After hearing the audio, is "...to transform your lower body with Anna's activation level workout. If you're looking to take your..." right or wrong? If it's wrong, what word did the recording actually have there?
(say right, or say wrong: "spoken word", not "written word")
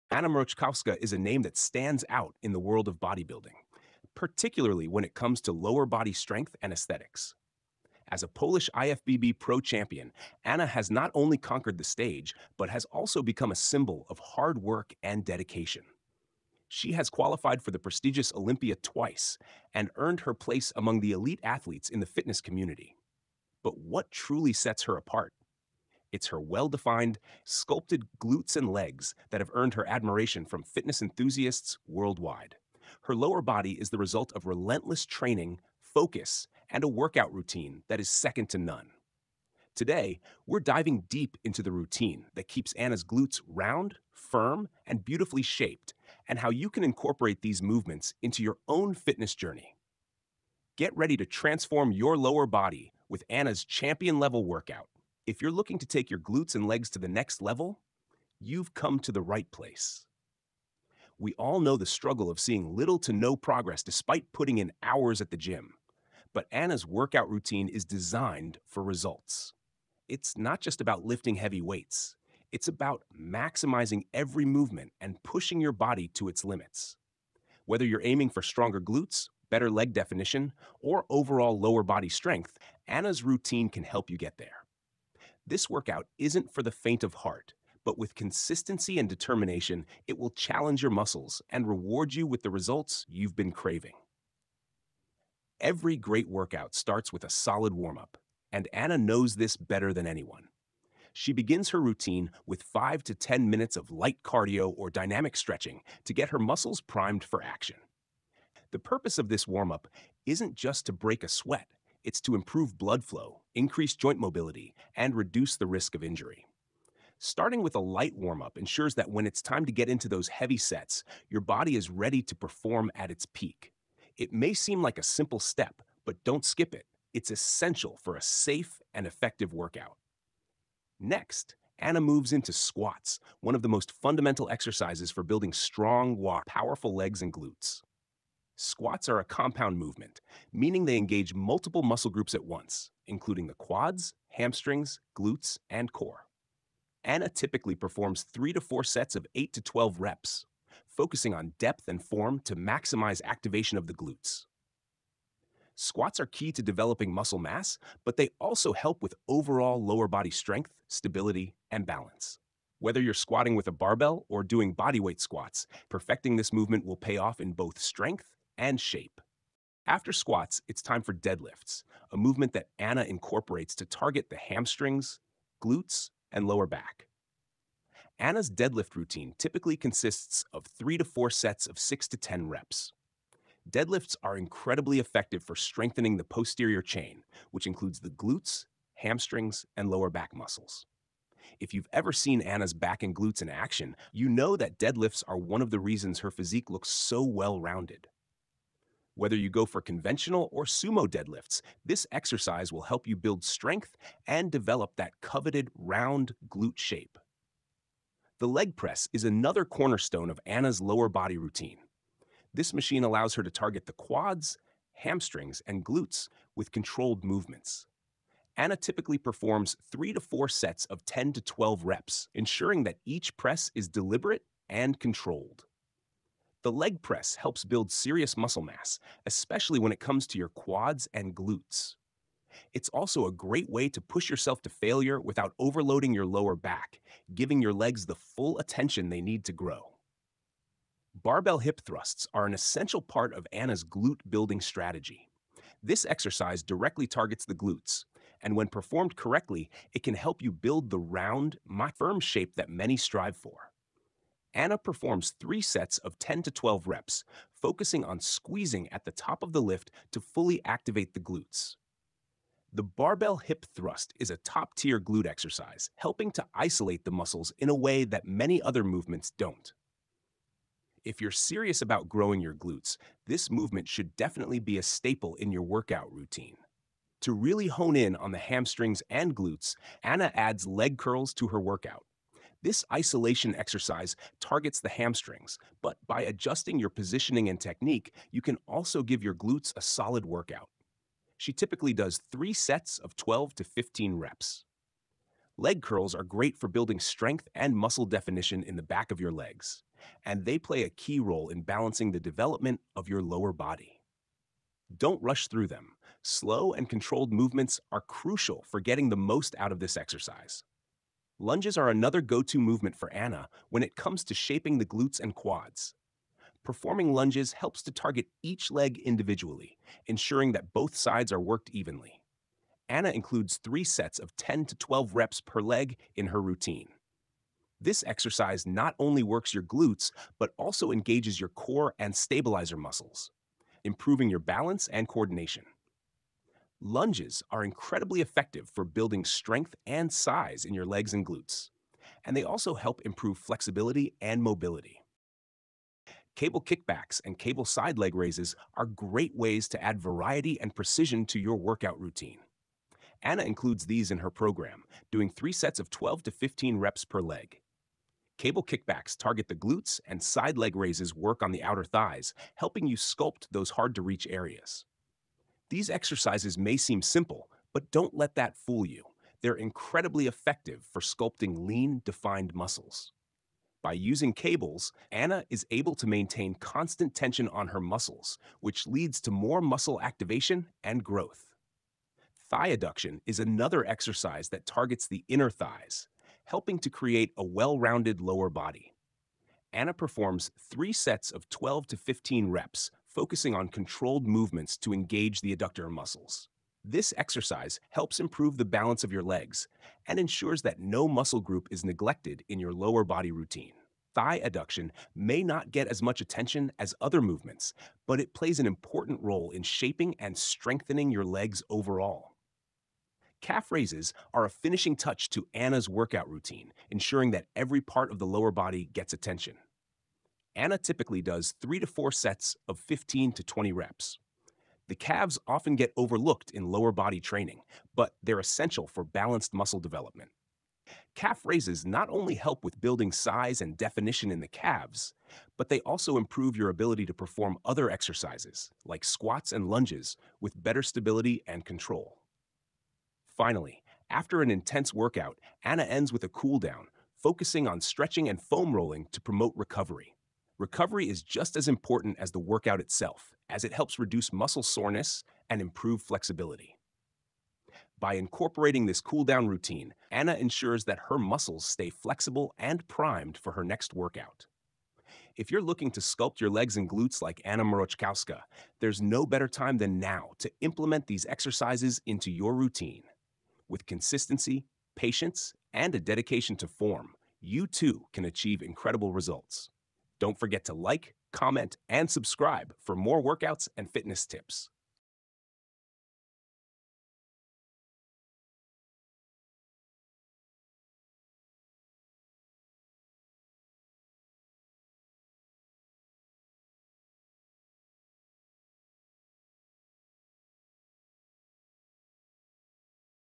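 wrong: "champion", not "activation".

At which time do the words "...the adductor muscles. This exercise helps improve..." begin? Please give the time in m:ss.
6:35.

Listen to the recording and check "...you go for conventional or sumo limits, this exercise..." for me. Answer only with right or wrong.
wrong.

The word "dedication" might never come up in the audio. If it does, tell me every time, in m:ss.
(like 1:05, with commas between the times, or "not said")
0:15, 7:55.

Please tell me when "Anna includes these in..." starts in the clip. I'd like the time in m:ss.
5:53.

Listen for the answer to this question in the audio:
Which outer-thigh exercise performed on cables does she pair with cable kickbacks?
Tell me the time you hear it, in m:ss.
5:47.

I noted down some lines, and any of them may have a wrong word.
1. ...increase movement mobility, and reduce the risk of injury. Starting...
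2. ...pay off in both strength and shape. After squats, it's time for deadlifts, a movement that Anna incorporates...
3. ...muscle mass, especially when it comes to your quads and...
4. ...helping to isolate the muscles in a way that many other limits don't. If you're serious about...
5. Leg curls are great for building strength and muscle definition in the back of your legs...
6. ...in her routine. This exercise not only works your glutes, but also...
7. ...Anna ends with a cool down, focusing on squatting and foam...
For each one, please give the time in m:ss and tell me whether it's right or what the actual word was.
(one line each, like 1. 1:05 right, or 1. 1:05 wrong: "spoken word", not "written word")
1. 1:53 wrong: "joint", not "movement"
2. 2:46 right
3. 3:48 right
4. 4:25 wrong: "movements", not "limits"
5. 4:55 right
6. 5:26 right
7. 7:25 wrong: "stretching", not "squatting".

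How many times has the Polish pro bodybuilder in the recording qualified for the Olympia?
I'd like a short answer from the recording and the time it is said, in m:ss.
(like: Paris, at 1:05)
2, at 0:18.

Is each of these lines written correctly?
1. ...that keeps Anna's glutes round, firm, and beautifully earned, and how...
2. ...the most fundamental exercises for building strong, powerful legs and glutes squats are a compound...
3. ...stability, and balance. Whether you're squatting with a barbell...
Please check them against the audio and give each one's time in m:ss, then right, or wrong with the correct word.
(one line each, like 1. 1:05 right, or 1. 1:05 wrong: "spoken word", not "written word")
1. 0:42 wrong: "shaped", not "earned"
2. 2:13 right
3. 2:40 right.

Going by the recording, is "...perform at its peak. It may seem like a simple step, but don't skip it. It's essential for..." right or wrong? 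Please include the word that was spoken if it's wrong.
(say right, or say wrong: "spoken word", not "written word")
right.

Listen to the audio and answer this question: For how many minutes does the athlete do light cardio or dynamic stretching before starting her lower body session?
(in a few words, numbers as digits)
5 to 10.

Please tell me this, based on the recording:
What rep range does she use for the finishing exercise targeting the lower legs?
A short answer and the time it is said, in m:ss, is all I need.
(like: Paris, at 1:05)
15 to 20, at 7:02.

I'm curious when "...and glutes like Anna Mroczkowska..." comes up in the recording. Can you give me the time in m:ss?
7:46.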